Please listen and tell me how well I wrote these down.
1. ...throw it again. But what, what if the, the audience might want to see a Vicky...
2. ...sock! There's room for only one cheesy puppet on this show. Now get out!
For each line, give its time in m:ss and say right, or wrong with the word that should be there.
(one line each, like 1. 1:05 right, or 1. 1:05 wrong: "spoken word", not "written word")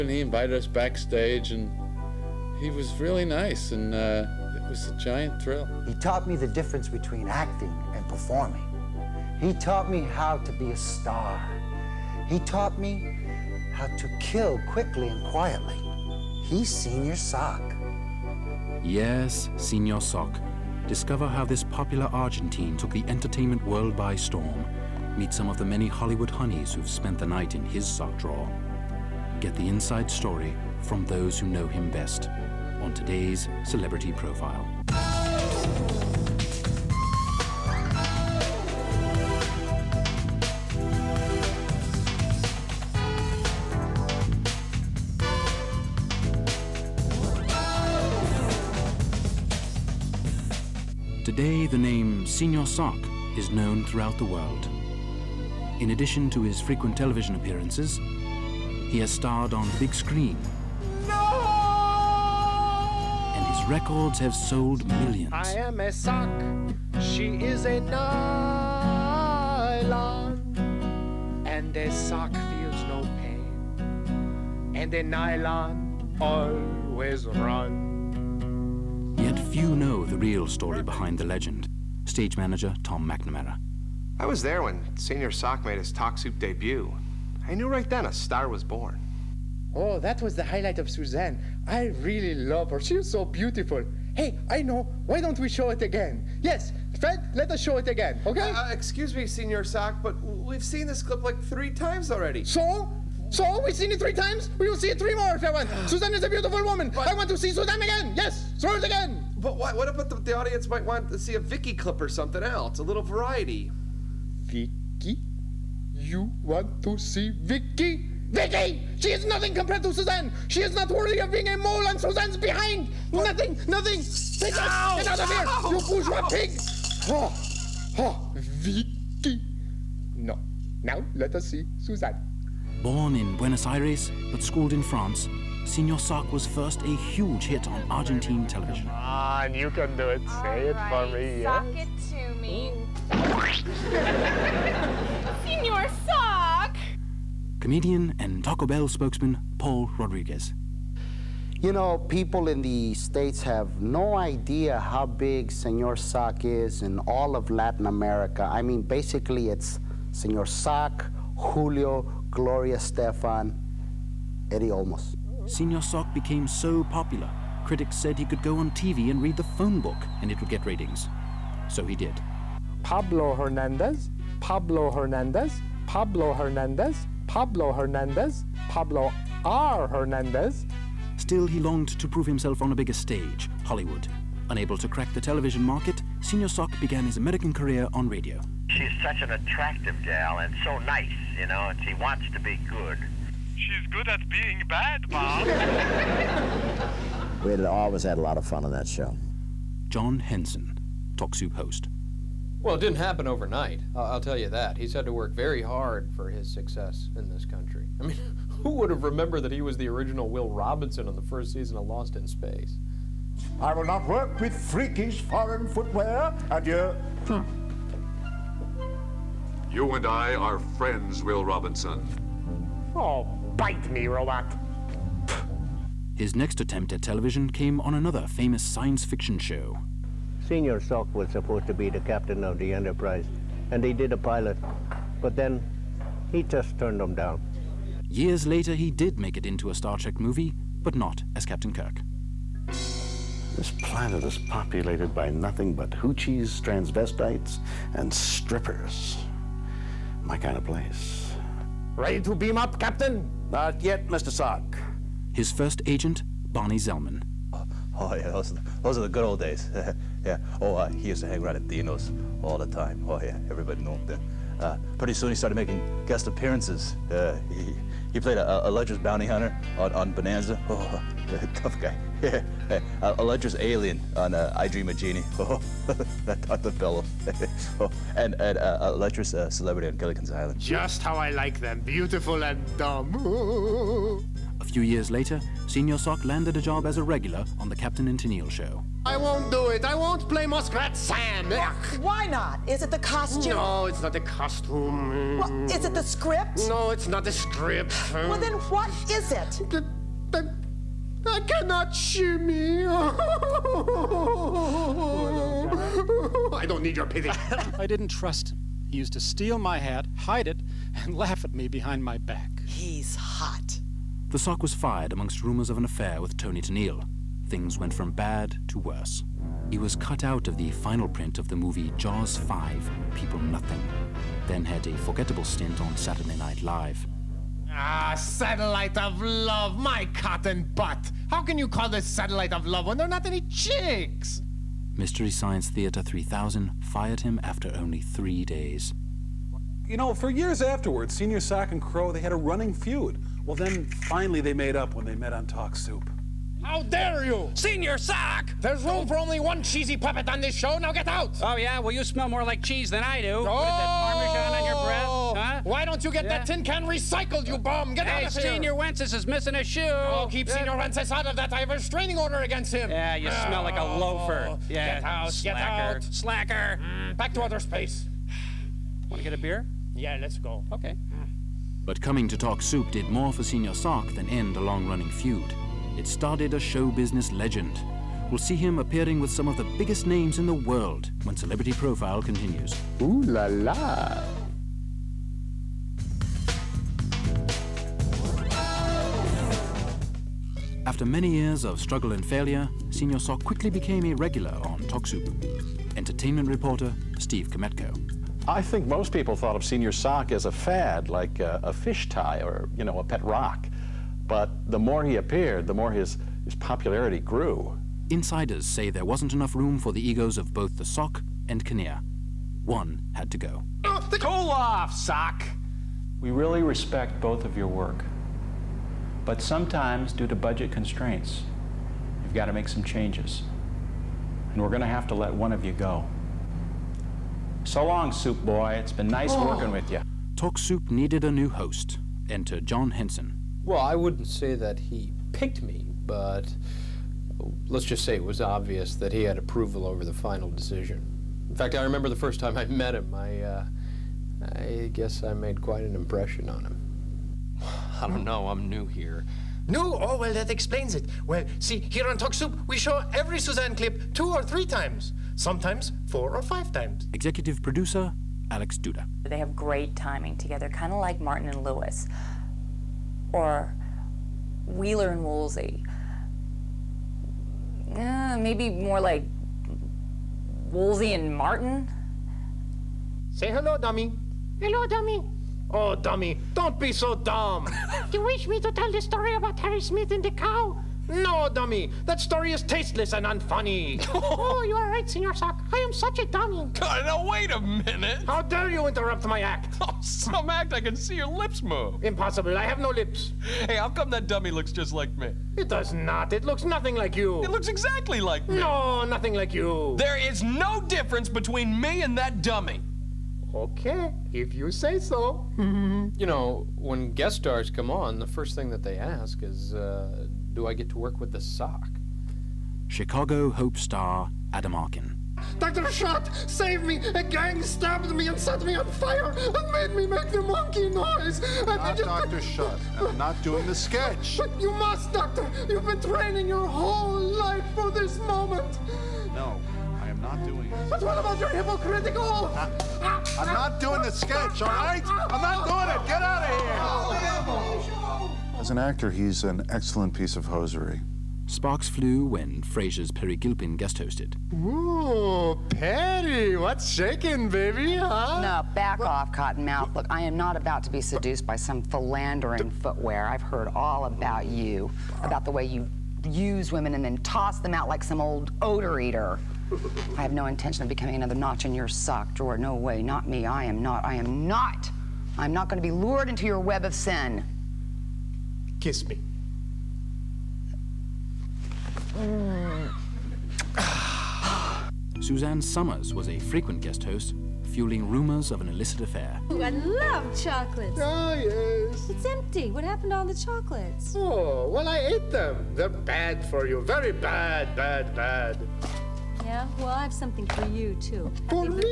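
1. 1:48 right
2. 5:47 right.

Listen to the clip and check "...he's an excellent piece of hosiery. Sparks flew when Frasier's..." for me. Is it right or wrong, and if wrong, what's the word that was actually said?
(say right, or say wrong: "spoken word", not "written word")
right.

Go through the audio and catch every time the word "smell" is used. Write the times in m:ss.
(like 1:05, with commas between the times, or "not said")
5:52, 6:03.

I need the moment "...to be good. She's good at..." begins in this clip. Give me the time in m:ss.
3:12.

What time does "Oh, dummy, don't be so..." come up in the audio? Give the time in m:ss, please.
7:55.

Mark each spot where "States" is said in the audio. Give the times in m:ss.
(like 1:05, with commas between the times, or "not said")
2:32.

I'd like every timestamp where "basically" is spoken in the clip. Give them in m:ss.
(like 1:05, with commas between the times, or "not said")
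2:38.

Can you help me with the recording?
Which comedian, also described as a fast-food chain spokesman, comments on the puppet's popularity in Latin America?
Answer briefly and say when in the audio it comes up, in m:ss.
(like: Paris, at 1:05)
Paul Rodriguez, at 2:29.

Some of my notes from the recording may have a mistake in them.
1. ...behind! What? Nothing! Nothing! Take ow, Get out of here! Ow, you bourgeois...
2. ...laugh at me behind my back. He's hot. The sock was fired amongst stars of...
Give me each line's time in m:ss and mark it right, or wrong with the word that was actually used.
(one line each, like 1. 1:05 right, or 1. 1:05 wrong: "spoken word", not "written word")
1. 2:02 right
2. 5:11 wrong: "rumors", not "stars".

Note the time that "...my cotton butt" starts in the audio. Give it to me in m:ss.
5:29.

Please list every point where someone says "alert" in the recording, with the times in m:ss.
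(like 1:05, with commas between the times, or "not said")
not said.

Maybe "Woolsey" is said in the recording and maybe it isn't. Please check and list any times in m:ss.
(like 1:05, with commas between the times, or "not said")
7:45, 7:50.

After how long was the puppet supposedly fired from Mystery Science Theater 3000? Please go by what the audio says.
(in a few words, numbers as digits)
3 days.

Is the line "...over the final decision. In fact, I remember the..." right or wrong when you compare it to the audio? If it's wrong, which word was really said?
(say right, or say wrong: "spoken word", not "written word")
right.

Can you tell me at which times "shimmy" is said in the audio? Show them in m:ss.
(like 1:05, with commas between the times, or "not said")
5:01.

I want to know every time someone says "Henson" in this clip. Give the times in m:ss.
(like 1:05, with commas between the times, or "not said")
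3:20, 7:12.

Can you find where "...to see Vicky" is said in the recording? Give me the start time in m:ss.
1:56.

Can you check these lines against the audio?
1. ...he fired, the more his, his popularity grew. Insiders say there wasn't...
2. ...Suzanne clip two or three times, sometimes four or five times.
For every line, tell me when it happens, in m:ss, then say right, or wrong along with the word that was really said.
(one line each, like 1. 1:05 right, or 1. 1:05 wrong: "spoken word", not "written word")
1. 6:45 wrong: "appeared", not "fired"
2. 7:33 right.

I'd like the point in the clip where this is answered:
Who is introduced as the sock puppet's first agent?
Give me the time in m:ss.
4:16.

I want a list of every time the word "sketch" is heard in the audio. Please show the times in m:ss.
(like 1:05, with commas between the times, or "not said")
8:43, 8:54.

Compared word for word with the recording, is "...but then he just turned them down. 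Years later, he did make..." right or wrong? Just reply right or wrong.
right.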